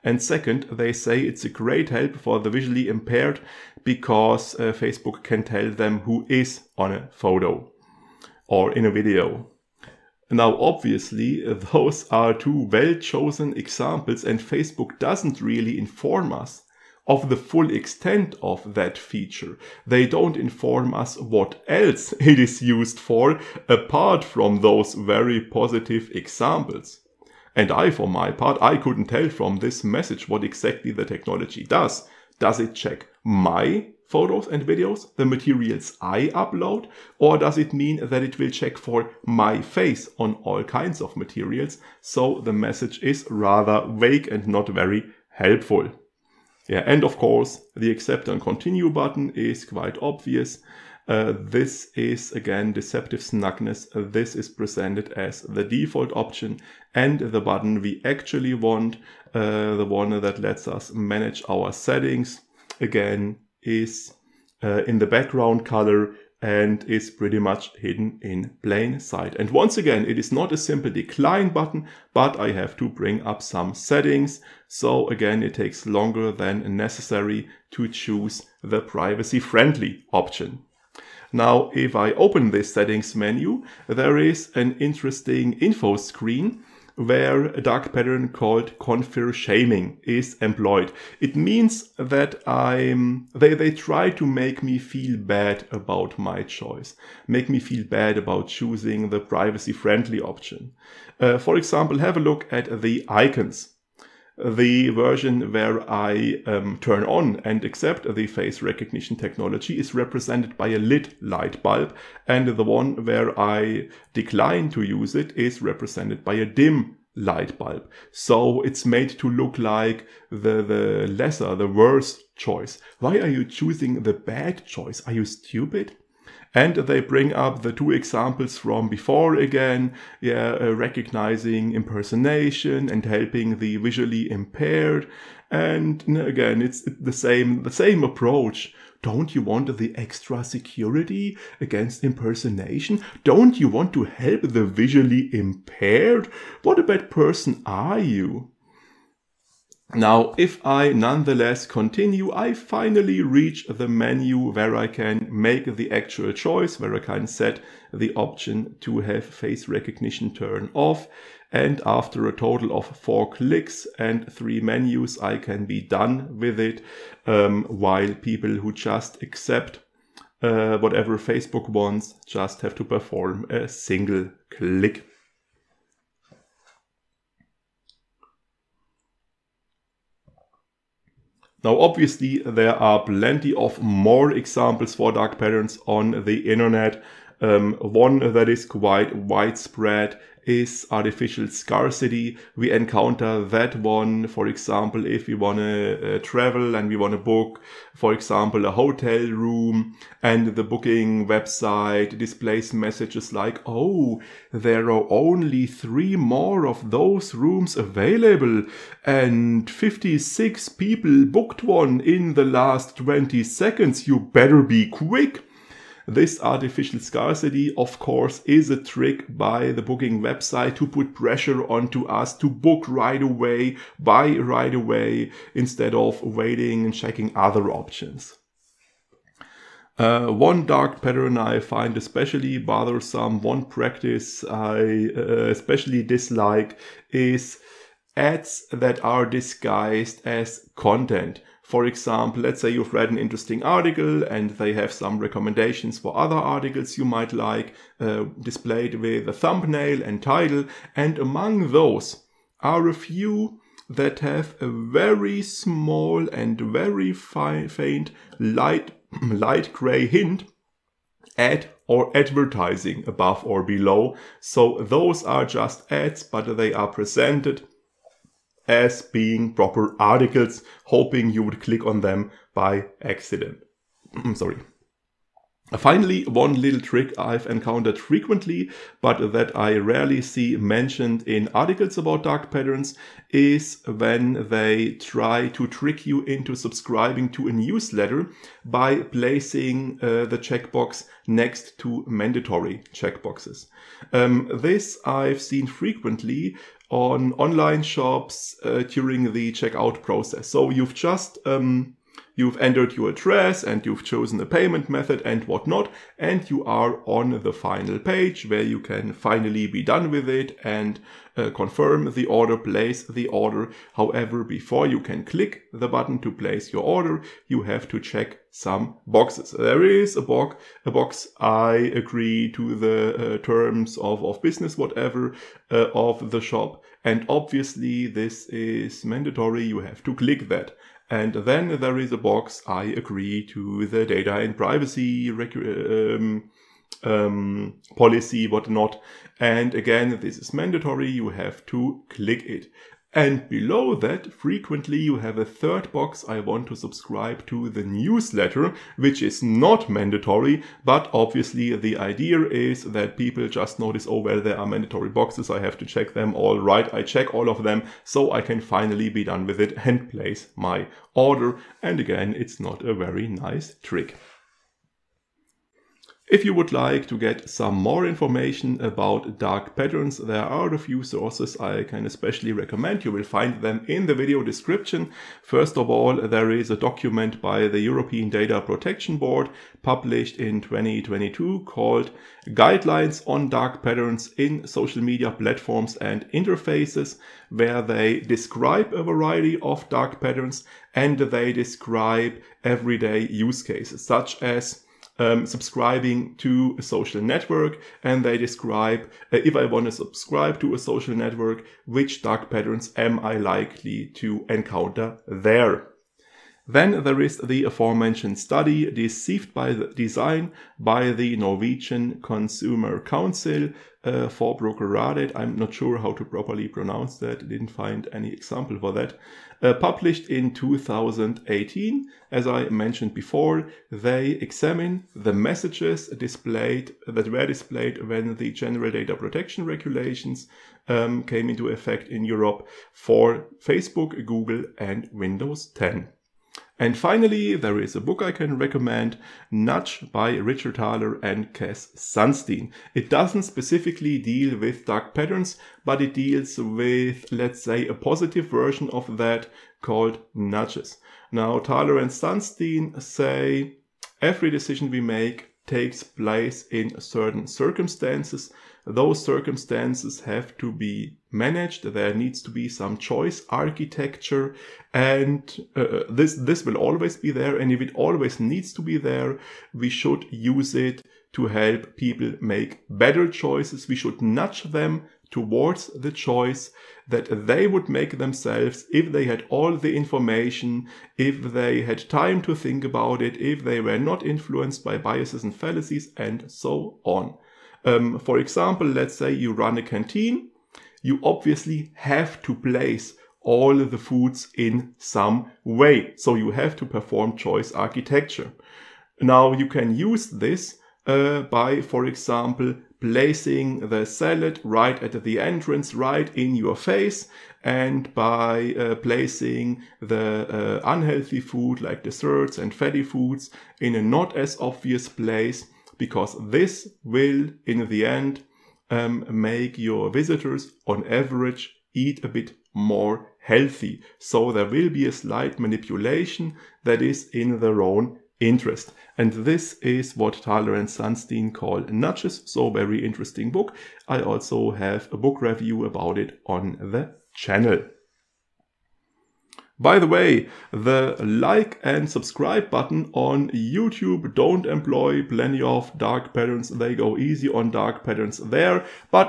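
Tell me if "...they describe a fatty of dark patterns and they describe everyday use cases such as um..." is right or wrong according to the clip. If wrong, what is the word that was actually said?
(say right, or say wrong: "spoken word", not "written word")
wrong: "variety", not "fatty".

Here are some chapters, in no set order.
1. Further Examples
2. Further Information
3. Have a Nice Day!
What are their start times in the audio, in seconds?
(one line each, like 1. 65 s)
1. 180 s
2. 364 s
3. 538 s.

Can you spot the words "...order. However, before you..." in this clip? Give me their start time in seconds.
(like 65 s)
313 s.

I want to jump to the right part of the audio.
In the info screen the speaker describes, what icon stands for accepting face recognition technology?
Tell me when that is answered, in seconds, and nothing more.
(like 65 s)
110 s.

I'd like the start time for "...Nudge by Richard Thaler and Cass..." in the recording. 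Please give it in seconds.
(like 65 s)
439 s.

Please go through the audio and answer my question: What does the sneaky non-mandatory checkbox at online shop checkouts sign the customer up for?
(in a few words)
the newsletter.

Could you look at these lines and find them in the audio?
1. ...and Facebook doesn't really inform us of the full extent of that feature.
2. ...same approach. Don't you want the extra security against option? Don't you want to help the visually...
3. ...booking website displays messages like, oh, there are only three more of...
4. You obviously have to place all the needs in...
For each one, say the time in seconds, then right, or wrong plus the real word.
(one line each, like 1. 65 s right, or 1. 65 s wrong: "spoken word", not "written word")
1. 14 s right
2. 137 s wrong: "impersonation", not "option"
3. 200 s right
4. 491 s wrong: "foods", not "needs".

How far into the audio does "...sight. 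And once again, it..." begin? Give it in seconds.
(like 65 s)
69 s.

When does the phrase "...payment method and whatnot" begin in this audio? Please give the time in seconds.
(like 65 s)
304 s.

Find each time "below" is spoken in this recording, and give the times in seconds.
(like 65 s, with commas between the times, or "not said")
263 s, 343 s.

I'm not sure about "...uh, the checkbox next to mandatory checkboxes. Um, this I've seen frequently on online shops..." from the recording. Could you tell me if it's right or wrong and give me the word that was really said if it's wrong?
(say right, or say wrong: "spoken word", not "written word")
right.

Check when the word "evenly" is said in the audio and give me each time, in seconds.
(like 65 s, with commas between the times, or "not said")
not said.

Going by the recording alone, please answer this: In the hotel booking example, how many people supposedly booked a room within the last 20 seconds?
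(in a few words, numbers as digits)
56.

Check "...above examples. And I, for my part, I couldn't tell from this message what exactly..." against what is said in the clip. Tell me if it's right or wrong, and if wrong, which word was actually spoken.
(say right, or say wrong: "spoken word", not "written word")
wrong: "positive", not "above".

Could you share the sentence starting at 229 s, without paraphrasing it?
Uh, one dark pattern I find especially bothersome, one practice I uh, especially dislike is ads that are disguised as content.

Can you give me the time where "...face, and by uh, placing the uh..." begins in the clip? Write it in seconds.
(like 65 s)
506 s.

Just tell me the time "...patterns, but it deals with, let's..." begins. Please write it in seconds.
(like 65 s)
445 s.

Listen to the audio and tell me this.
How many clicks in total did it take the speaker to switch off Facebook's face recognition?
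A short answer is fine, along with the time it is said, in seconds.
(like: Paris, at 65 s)
4, at 162 s.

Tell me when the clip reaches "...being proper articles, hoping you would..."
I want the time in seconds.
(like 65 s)
269 s.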